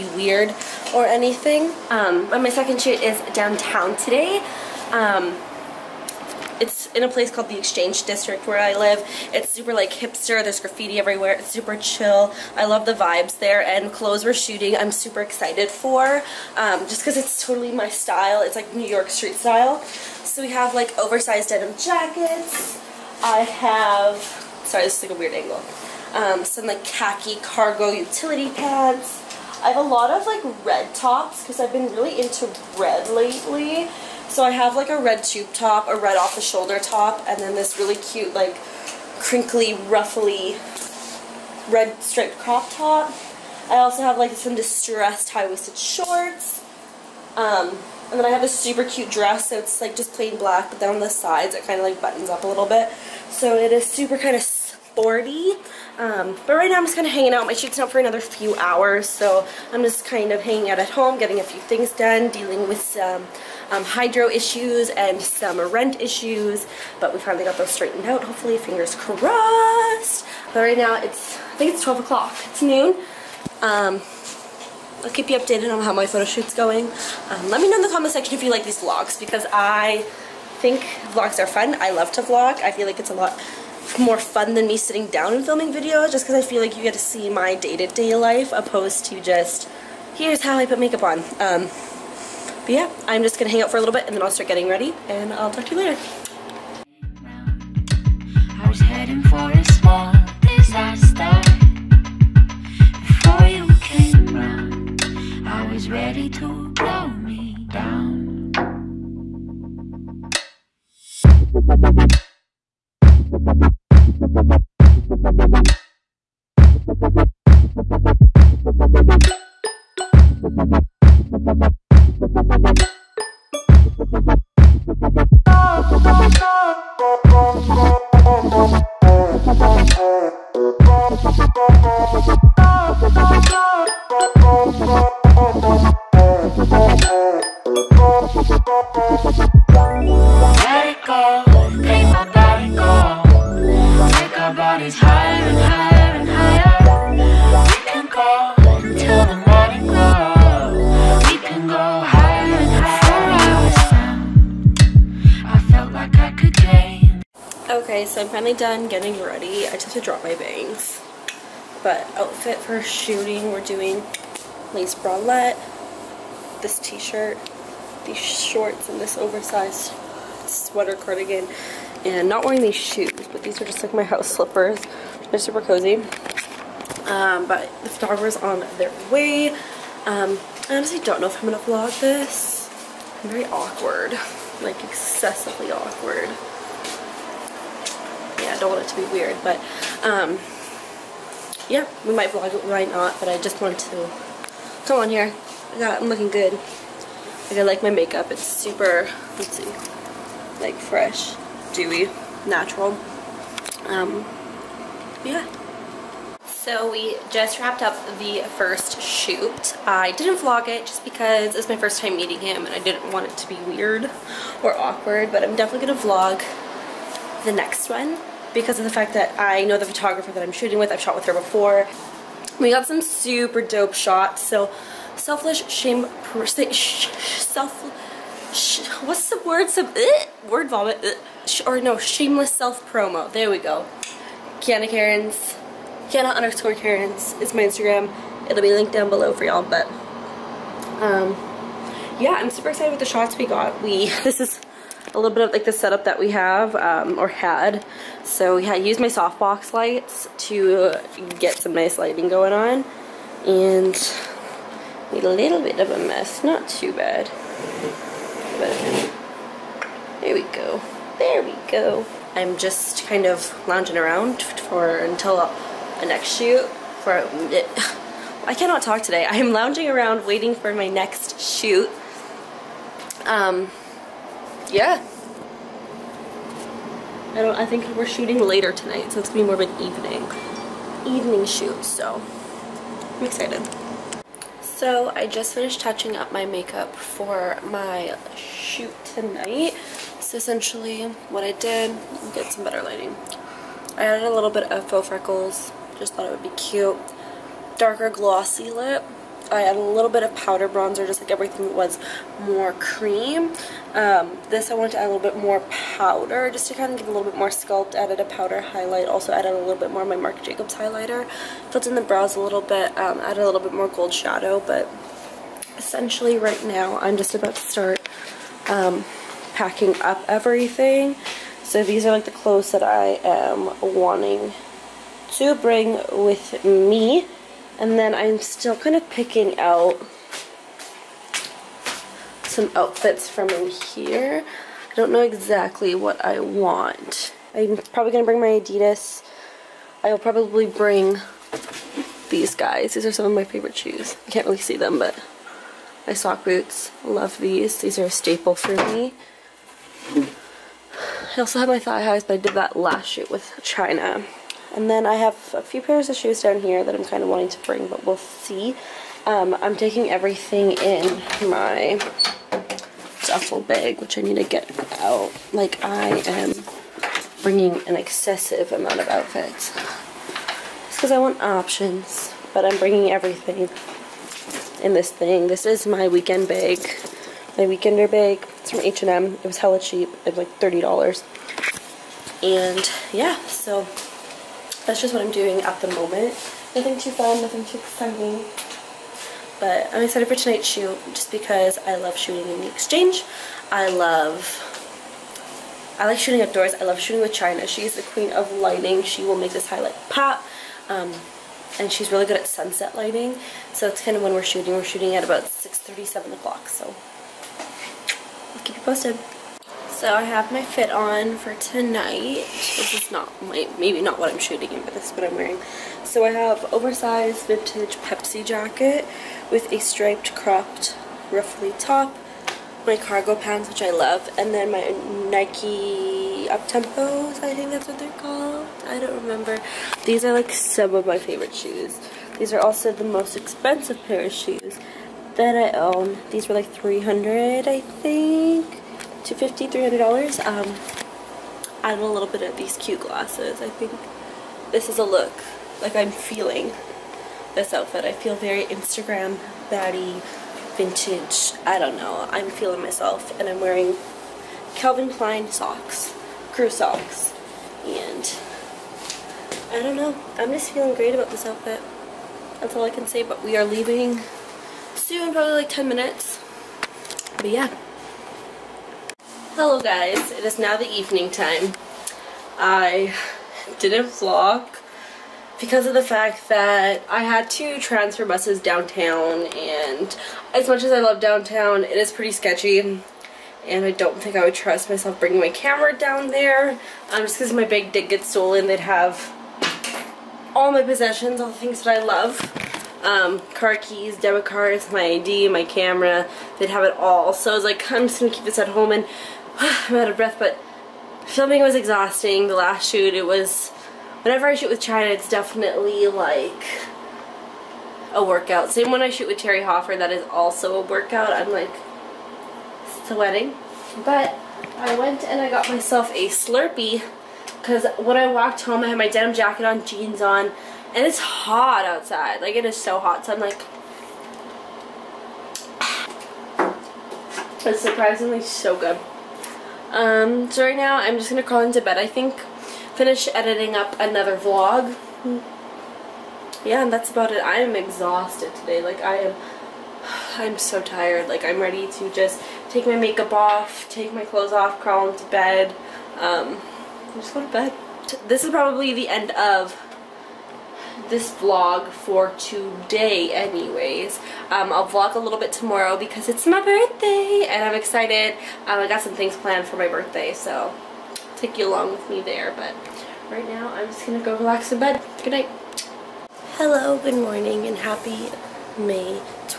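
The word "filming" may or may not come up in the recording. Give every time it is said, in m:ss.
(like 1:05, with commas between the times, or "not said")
1:25, 8:21.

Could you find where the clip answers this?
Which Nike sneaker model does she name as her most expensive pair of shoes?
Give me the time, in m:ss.
7:06.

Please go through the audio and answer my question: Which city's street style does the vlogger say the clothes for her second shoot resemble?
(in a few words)
New York.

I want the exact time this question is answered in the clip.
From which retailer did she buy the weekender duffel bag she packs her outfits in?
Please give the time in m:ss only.
6:18.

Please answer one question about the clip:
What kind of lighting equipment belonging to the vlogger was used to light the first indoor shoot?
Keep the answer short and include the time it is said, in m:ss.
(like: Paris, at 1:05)
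softbox lights, at 4:09.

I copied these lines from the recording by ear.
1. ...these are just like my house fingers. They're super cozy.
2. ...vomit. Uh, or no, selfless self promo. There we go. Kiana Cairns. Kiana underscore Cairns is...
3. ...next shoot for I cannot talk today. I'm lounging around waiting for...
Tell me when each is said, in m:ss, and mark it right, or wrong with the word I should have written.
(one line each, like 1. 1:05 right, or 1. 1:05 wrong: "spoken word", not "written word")
1. 2:53 wrong: "slippers", not "fingers"
2. 3:50 wrong: "shameless", not "selfless"
3. 4:26 right.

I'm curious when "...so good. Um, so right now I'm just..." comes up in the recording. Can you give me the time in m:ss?
8:48.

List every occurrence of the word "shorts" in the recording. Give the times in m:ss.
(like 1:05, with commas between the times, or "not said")
0:45, 2:48.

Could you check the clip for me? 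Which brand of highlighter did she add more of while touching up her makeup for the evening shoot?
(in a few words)
Marc Jacobs.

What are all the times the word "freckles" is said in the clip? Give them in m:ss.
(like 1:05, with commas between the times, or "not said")
4:55.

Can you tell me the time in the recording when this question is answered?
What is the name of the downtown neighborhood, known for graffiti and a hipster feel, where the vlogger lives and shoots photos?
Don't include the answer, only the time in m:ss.
0:07.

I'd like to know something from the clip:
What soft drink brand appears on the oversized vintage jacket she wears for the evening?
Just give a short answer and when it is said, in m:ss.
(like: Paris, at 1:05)
Pepsi, at 6:57.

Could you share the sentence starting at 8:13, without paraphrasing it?
Um, car keys, debit cards, my ID, my camera, they'd have it all.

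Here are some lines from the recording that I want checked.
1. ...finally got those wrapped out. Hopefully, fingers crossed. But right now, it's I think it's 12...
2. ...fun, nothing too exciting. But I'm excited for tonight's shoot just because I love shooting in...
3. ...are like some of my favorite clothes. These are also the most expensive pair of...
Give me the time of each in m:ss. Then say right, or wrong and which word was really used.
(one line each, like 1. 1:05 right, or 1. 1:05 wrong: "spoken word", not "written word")
1. 1:07 wrong: "straightened", not "wrapped"
2. 6:27 right
3. 7:10 wrong: "shoes", not "clothes".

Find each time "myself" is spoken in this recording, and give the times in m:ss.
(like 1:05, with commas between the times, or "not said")
7:32, 8:04, 8:35.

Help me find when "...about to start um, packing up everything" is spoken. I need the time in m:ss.
5:17.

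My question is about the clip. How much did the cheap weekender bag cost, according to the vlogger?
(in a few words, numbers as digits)
$30.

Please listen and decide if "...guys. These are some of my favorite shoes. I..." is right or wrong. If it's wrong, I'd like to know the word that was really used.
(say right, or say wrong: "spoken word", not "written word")
right.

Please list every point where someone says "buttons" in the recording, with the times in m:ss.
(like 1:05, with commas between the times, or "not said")
0:52, 4:18.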